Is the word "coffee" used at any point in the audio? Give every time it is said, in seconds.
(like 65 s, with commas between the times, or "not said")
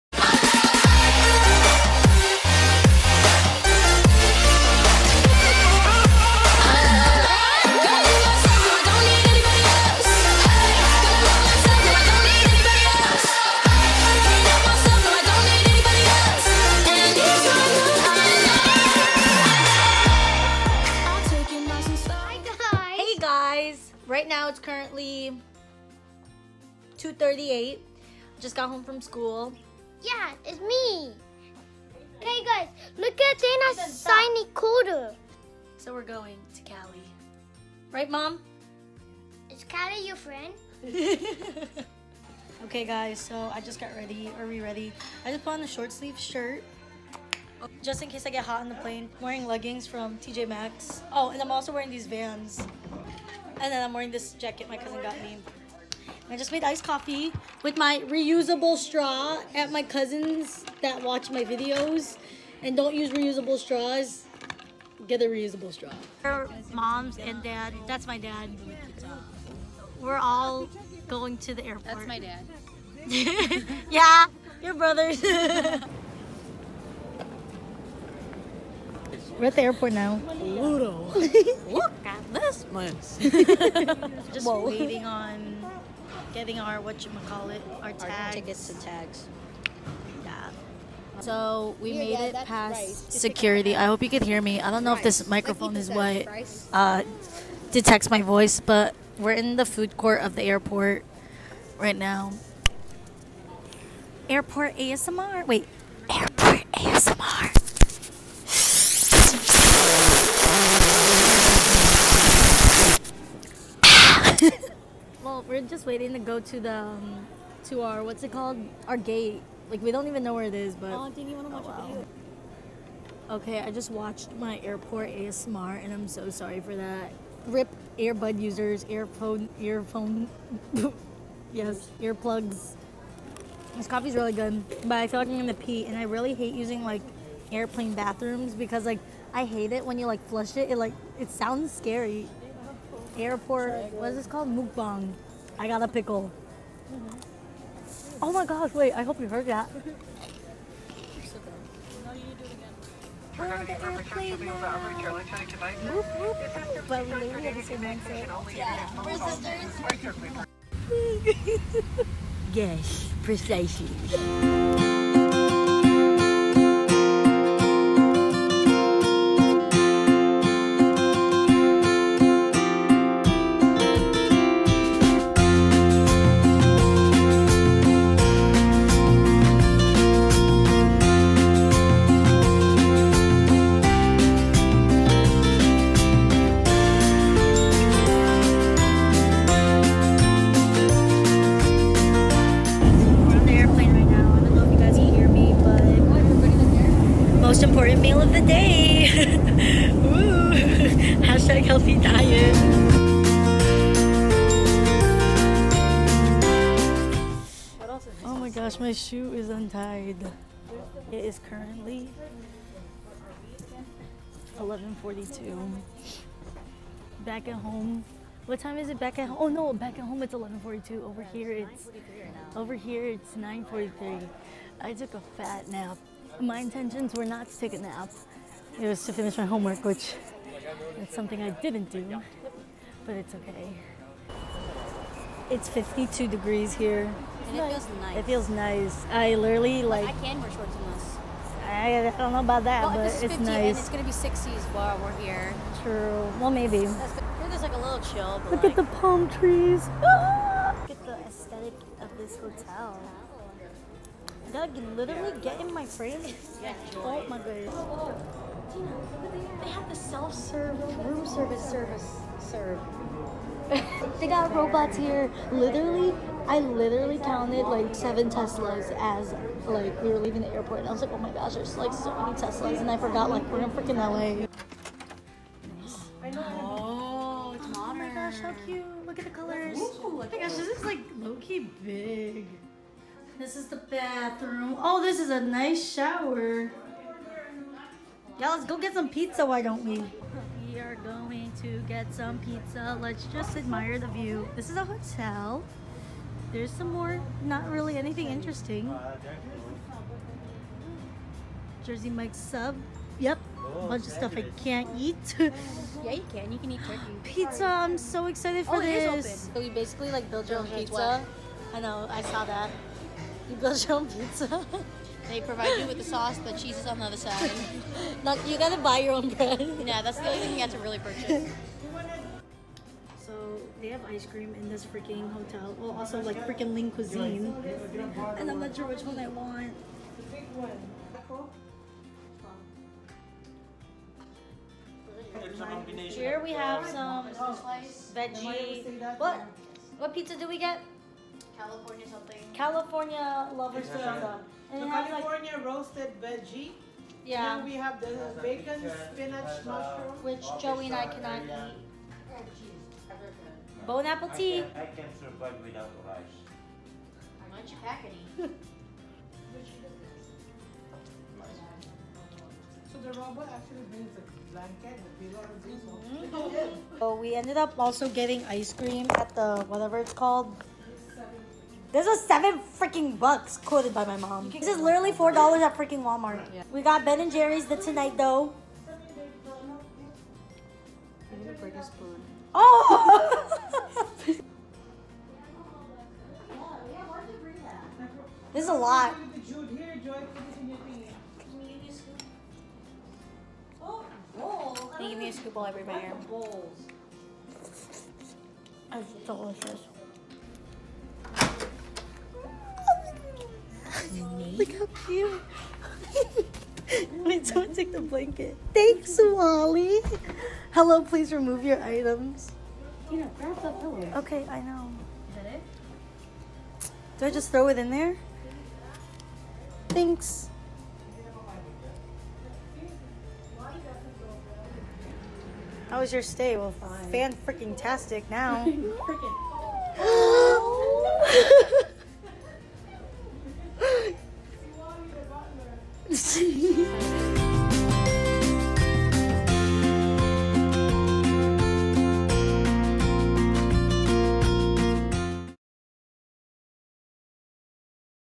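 56 s, 133 s.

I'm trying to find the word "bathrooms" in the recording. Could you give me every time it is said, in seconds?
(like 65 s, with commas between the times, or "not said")
137 s, 283 s.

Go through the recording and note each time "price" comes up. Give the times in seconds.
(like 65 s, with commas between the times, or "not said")
94 s.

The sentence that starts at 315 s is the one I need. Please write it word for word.
They provide you with the sauce, the cheese is on the other side.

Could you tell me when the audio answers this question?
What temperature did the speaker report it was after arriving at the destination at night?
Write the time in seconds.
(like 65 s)
235 s.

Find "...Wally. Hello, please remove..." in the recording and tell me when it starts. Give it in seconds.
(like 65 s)
409 s.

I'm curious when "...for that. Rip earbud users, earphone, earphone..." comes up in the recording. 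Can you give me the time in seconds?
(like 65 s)
126 s.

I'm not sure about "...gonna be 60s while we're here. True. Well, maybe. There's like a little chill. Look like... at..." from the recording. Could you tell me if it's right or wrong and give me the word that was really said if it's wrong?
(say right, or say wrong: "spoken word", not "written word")
right.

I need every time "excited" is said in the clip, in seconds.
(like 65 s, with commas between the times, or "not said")
308 s.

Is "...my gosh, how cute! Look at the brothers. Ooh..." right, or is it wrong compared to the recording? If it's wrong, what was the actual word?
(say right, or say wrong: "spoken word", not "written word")
wrong: "colors", not "brothers".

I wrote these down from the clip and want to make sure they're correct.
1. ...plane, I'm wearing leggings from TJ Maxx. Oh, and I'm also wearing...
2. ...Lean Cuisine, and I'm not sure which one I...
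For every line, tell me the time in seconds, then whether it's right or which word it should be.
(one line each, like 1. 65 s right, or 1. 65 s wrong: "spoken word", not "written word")
1. 48 s right
2. 326 s right.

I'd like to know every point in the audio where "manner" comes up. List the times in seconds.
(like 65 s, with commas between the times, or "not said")
not said.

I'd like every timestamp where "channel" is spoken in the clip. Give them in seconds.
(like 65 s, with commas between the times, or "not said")
not said.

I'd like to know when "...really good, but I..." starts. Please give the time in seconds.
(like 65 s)
134 s.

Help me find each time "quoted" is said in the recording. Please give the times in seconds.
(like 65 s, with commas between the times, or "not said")
373 s.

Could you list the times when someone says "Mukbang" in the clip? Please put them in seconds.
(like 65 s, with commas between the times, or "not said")
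144 s.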